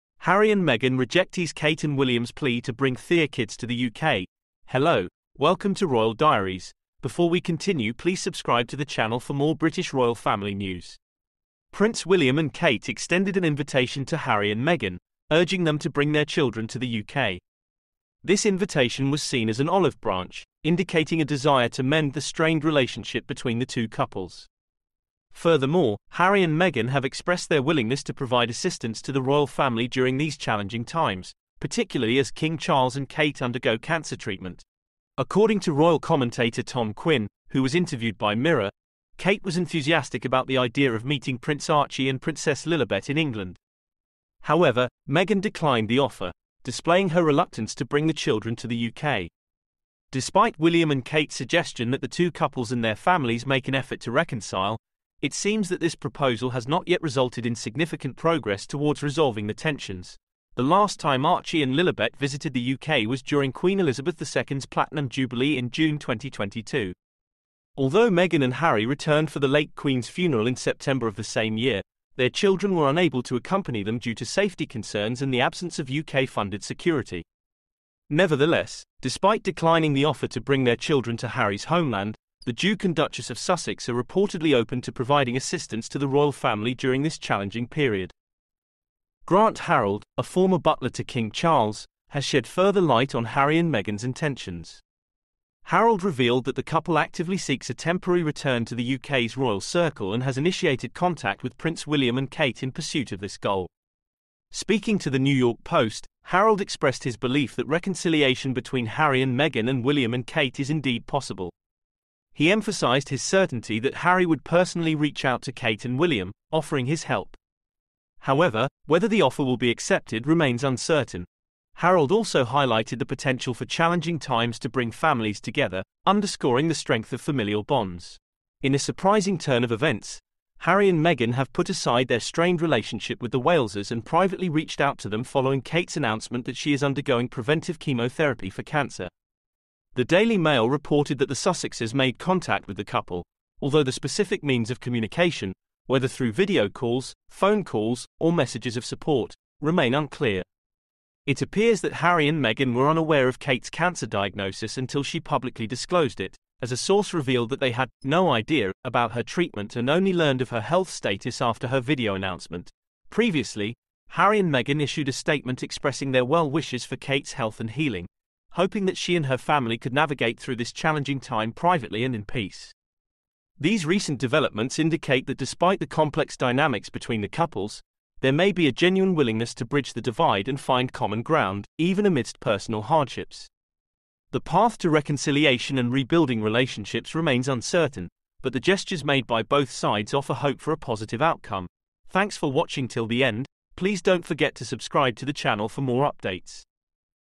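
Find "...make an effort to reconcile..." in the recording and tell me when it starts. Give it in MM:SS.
00:53.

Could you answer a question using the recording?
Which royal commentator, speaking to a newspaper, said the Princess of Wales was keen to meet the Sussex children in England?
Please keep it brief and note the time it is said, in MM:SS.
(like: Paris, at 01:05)
Tom Quinn, at 00:36.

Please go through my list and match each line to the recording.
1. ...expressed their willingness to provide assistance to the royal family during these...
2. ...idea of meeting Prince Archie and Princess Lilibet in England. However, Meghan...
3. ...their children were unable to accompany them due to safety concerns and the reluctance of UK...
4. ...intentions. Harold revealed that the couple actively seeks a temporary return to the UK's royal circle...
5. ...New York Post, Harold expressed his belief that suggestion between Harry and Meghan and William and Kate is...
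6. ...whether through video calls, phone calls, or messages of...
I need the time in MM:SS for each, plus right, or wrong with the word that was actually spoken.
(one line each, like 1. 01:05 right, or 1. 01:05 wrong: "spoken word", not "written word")
1. 00:27 right
2. 00:40 right
3. 01:12 wrong: "absence", not "reluctance"
4. 01:34 right
5. 01:45 wrong: "reconciliation", not "suggestion"
6. 02:25 right.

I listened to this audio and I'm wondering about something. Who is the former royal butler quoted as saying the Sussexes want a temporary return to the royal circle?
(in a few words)
Grant Harold.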